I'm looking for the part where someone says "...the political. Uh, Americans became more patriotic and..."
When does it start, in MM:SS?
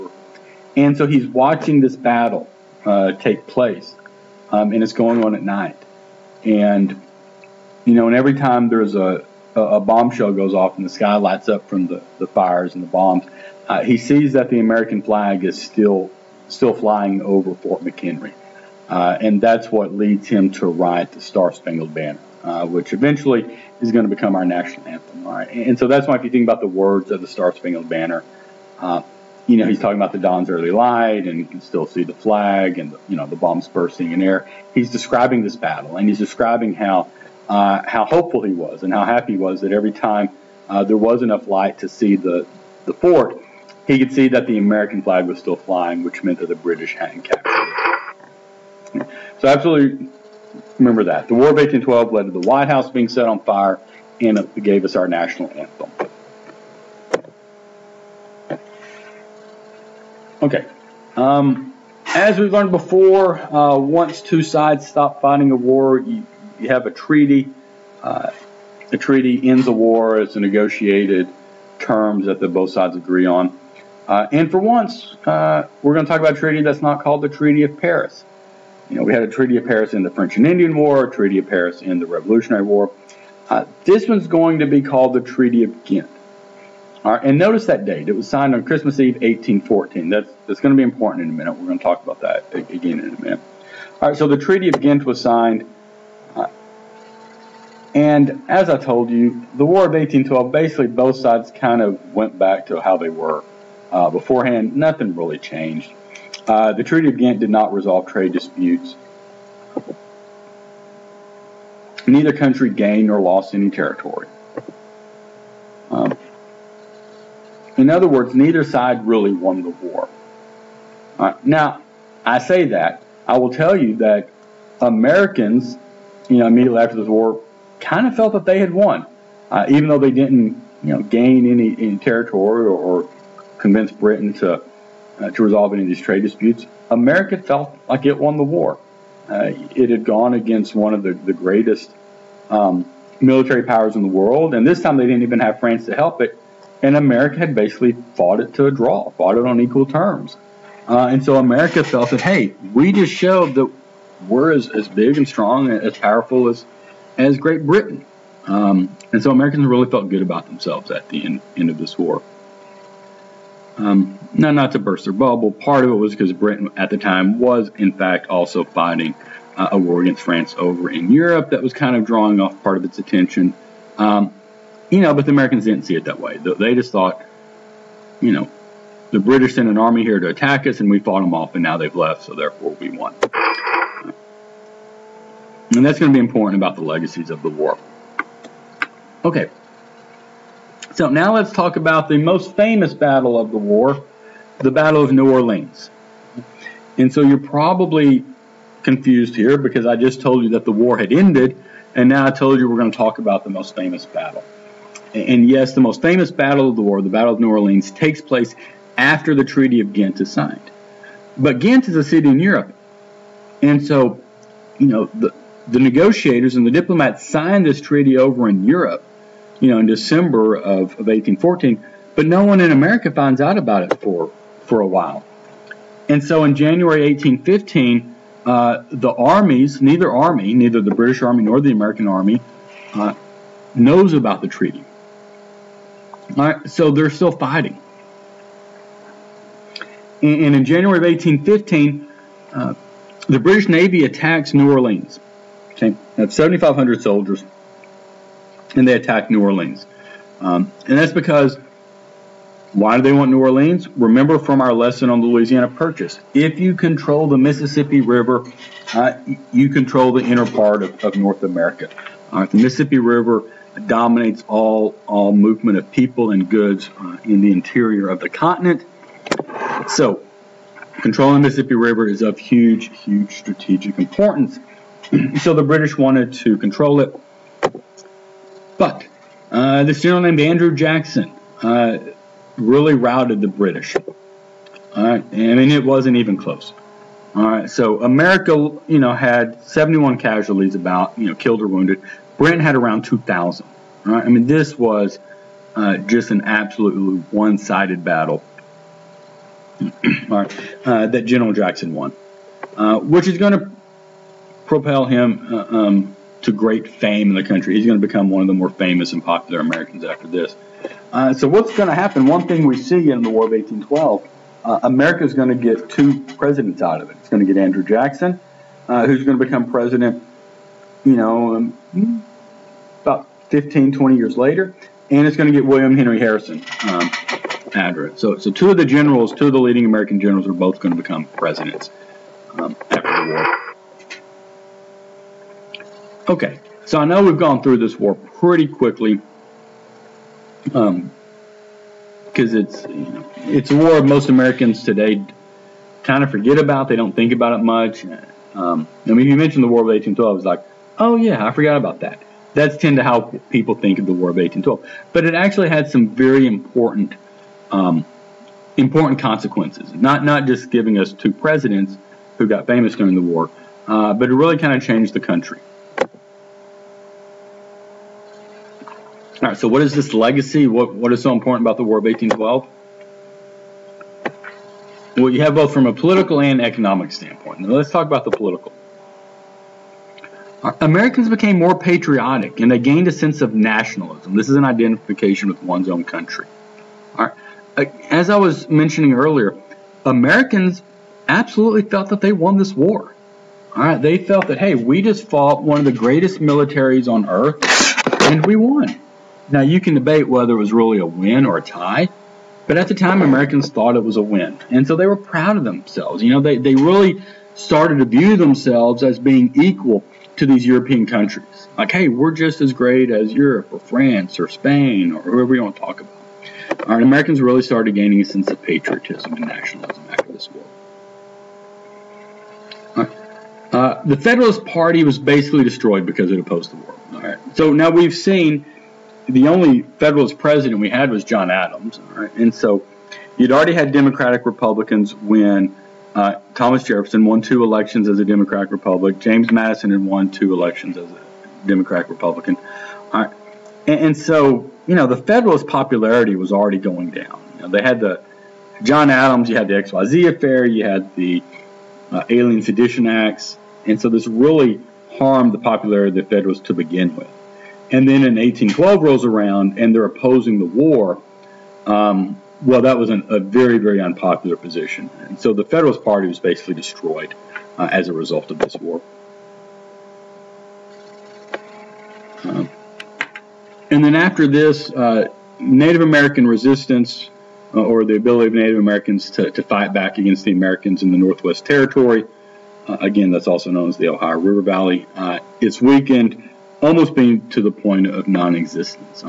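06:18.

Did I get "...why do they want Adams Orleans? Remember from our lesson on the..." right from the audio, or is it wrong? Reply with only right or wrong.
wrong.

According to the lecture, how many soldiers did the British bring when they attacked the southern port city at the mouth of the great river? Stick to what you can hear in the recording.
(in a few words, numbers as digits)
7,500.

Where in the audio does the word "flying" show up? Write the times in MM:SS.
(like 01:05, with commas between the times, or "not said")
00:16, 00:45.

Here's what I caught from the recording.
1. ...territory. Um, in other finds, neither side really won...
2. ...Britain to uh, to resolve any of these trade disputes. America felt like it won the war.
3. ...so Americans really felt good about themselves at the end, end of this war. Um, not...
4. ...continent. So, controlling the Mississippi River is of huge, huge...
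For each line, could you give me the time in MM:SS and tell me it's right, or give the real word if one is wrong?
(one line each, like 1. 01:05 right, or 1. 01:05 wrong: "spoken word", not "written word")
1. 01:53 wrong: "words", not "finds"
2. 02:13 right
3. 02:39 right
4. 04:28 right.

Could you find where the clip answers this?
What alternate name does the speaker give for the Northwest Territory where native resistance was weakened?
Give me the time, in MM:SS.
08:04.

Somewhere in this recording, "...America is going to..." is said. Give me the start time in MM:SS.
05:14.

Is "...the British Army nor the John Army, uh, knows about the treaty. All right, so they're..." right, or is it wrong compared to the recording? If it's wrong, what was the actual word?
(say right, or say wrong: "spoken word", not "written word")
wrong: "American", not "John".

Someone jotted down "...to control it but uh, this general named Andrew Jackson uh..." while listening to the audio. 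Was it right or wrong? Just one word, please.
right.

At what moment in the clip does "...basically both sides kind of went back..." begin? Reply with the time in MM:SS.
01:40.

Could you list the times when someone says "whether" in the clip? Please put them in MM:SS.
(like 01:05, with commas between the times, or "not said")
06:40.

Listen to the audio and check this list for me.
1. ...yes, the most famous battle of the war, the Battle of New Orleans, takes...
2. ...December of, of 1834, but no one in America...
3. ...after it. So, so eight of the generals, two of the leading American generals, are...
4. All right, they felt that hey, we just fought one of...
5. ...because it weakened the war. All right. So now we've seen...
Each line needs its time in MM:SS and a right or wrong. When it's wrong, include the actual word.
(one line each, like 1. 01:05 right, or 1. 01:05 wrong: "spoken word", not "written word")
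1. 03:25 right
2. 03:39 wrong: "1814", not "1834"
3. 05:27 wrong: "two", not "eight"
4. 06:33 right
5. 07:06 wrong: "opposed", not "weakened".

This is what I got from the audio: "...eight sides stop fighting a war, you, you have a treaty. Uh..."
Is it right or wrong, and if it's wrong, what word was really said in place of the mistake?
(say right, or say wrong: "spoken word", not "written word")
wrong: "two", not "eight".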